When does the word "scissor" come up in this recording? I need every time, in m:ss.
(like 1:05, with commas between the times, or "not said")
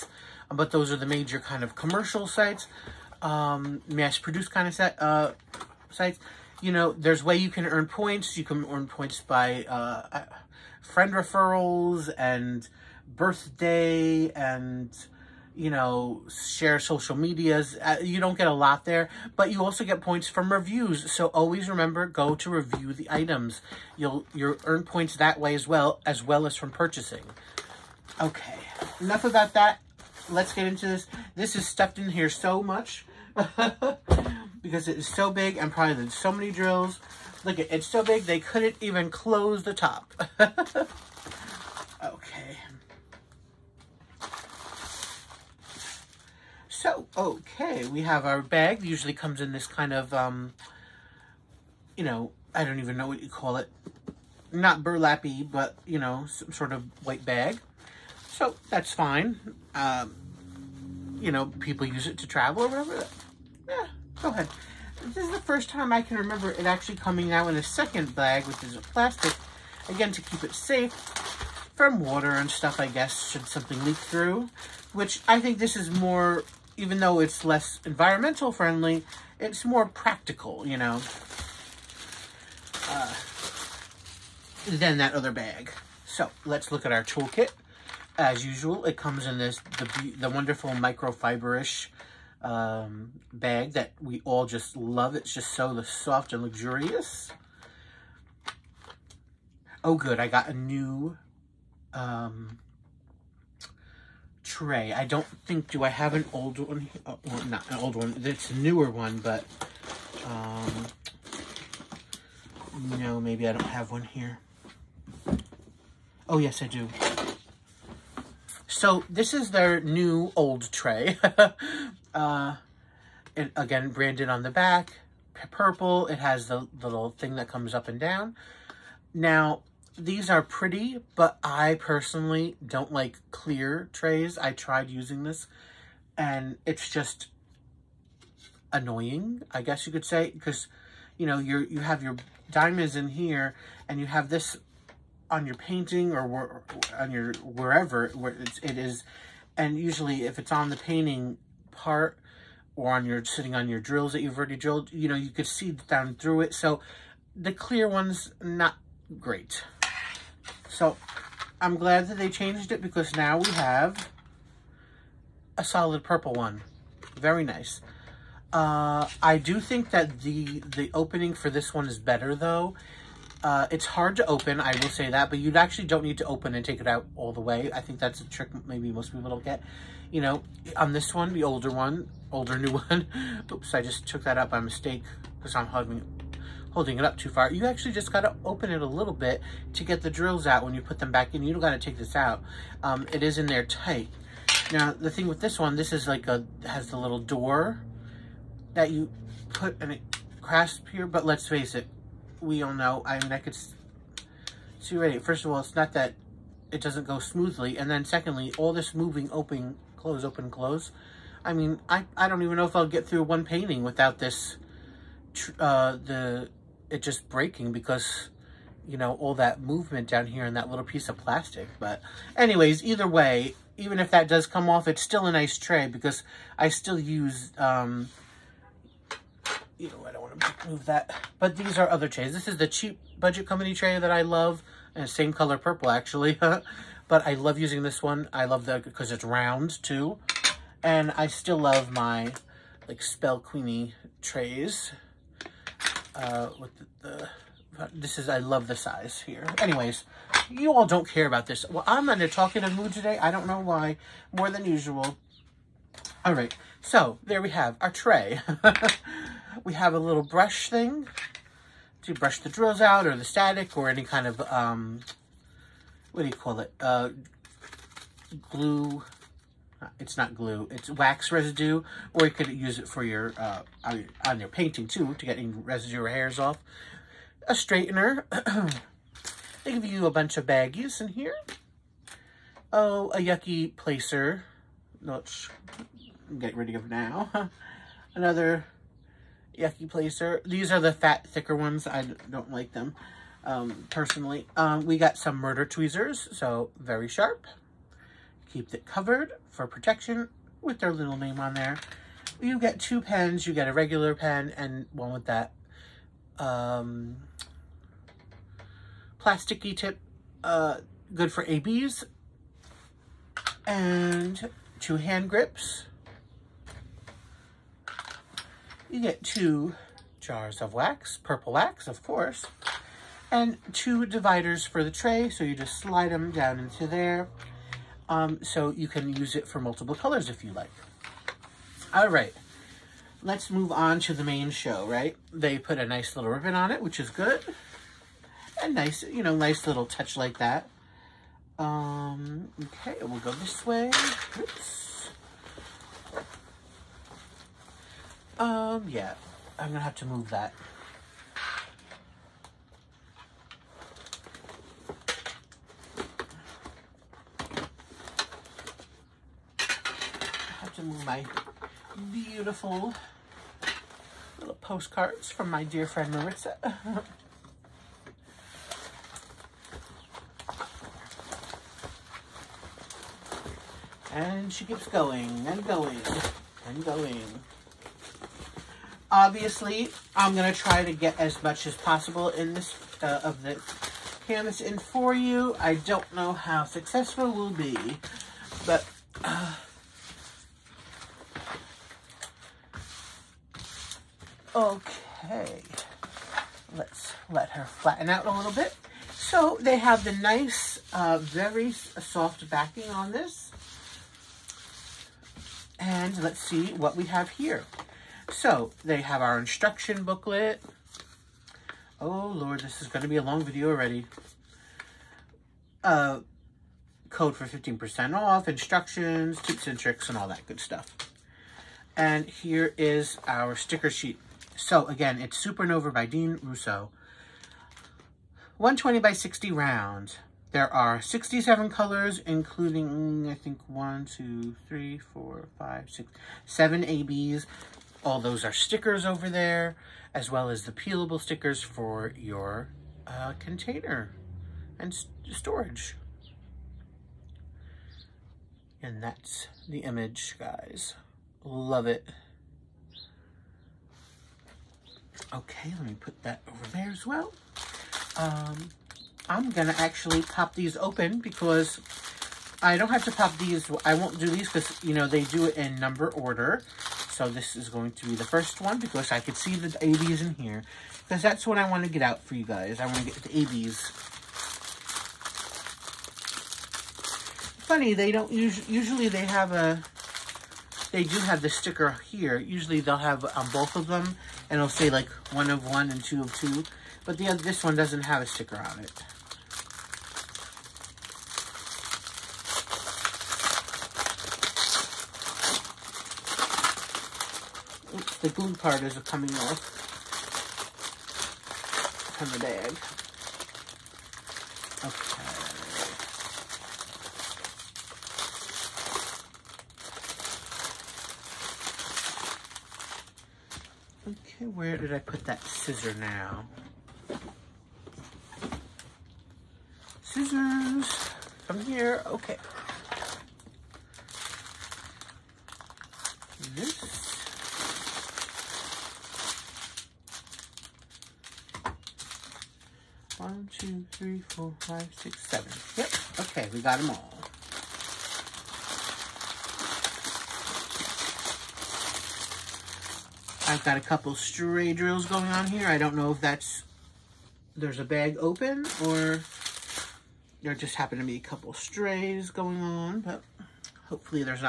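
8:35, 8:40.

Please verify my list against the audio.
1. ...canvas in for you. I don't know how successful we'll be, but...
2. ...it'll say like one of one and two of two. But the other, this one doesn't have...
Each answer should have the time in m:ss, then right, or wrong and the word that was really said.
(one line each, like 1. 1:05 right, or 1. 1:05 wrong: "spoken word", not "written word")
1. 6:24 right
2. 8:04 right.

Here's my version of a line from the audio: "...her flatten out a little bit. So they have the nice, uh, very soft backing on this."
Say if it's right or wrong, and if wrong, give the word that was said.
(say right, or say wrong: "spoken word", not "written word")
right.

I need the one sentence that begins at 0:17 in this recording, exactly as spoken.
Uh, you don't get a lot there, but you also get points from reviews.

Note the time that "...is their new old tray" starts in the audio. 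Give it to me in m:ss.
1:59.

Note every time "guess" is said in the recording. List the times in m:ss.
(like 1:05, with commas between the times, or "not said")
1:12, 2:19.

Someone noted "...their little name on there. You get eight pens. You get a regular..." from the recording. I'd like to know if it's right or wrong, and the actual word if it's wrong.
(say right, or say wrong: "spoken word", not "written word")
wrong: "two", not "eight".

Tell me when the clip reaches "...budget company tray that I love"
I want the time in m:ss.
3:53.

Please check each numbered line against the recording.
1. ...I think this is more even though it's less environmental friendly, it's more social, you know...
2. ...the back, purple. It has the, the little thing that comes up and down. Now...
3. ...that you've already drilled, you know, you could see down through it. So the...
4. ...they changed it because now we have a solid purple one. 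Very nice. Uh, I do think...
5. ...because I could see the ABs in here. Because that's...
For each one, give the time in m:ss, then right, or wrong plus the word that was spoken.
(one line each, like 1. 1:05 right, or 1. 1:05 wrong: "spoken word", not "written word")
1. 1:15 wrong: "practical", not "social"
2. 2:04 right
3. 2:34 right
4. 2:42 right
5. 7:48 right.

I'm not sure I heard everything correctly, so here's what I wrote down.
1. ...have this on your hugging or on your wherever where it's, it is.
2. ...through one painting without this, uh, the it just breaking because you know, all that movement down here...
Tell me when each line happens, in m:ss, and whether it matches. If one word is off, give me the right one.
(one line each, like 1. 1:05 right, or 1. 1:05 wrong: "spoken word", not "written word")
1. 2:24 wrong: "painting", not "hugging"
2. 3:33 right.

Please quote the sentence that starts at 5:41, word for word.
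Um, okay, we'll go this way.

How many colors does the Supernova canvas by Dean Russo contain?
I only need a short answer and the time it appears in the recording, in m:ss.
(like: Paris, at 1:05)
67, at 7:11.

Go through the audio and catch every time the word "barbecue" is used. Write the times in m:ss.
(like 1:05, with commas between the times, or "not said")
not said.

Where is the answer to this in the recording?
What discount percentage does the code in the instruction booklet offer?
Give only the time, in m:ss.
6:57.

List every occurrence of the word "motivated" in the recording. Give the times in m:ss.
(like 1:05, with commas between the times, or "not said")
not said.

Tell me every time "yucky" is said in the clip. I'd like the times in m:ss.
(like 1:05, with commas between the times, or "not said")
4:43, 4:49.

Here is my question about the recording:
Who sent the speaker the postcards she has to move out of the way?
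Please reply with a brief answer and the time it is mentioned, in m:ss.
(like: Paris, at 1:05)
Marissa, at 6:06.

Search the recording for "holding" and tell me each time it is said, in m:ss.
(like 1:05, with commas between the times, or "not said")
3:06.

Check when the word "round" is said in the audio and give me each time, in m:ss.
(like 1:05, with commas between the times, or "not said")
3:59, 7:09.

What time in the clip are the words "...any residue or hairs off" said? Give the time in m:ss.
4:35.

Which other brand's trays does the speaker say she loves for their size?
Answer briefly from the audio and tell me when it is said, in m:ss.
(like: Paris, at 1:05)
spell queenie, at 4:03.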